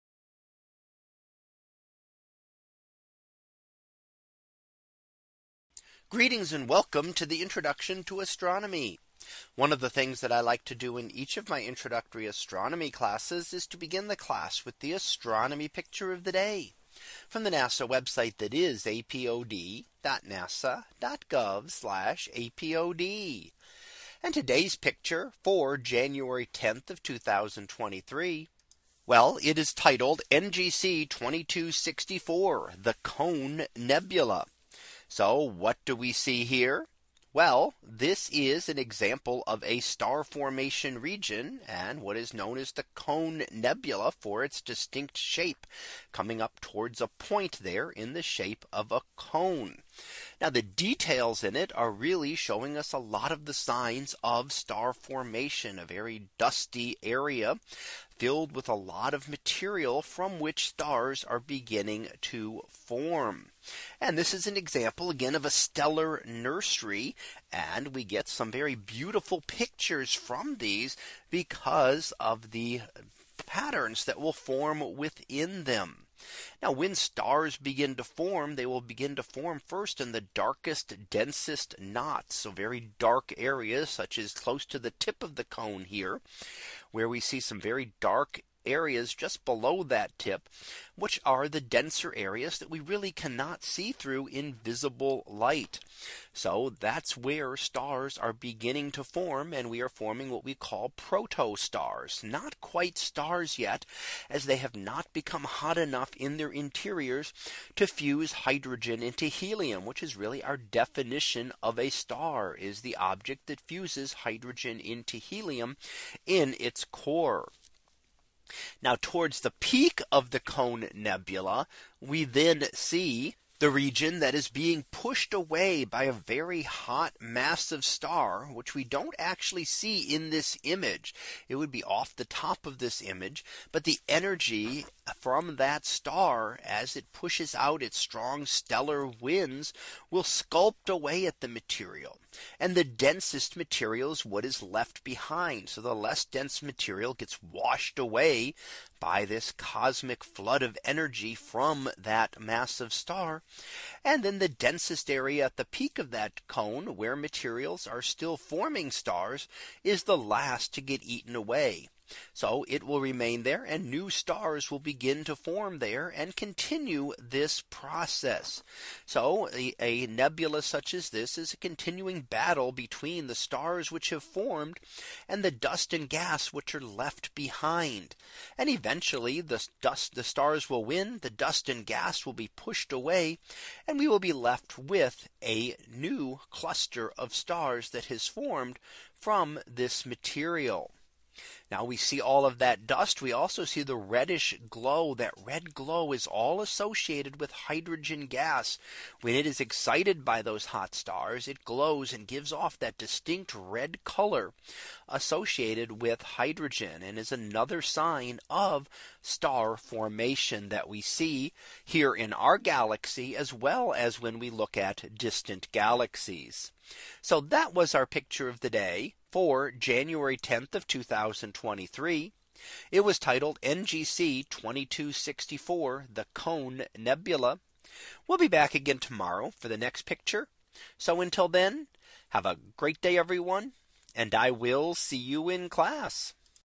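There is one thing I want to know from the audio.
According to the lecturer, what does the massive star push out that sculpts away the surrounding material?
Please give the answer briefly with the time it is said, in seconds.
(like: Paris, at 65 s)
strong stellar winds, at 137 s.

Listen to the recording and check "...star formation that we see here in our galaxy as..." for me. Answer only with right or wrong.
right.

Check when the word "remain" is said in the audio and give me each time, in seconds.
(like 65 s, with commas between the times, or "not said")
162 s.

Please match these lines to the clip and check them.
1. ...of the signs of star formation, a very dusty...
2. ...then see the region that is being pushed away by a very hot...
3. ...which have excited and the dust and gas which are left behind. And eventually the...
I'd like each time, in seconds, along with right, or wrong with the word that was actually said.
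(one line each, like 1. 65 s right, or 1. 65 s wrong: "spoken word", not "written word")
1. 53 s right
2. 122 s right
3. 173 s wrong: "formed", not "excited".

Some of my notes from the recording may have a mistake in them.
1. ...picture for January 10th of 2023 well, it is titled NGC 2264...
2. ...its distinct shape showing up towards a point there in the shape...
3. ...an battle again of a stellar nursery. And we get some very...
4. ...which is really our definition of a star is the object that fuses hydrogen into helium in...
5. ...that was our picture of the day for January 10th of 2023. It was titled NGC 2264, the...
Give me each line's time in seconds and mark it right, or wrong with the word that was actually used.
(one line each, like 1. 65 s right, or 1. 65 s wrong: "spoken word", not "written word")
1. 24 s right
2. 44 s wrong: "coming", not "showing"
3. 64 s wrong: "example", not "battle"
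4. 109 s right
5. 217 s right.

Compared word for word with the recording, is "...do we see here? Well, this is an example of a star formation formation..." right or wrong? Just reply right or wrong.
wrong.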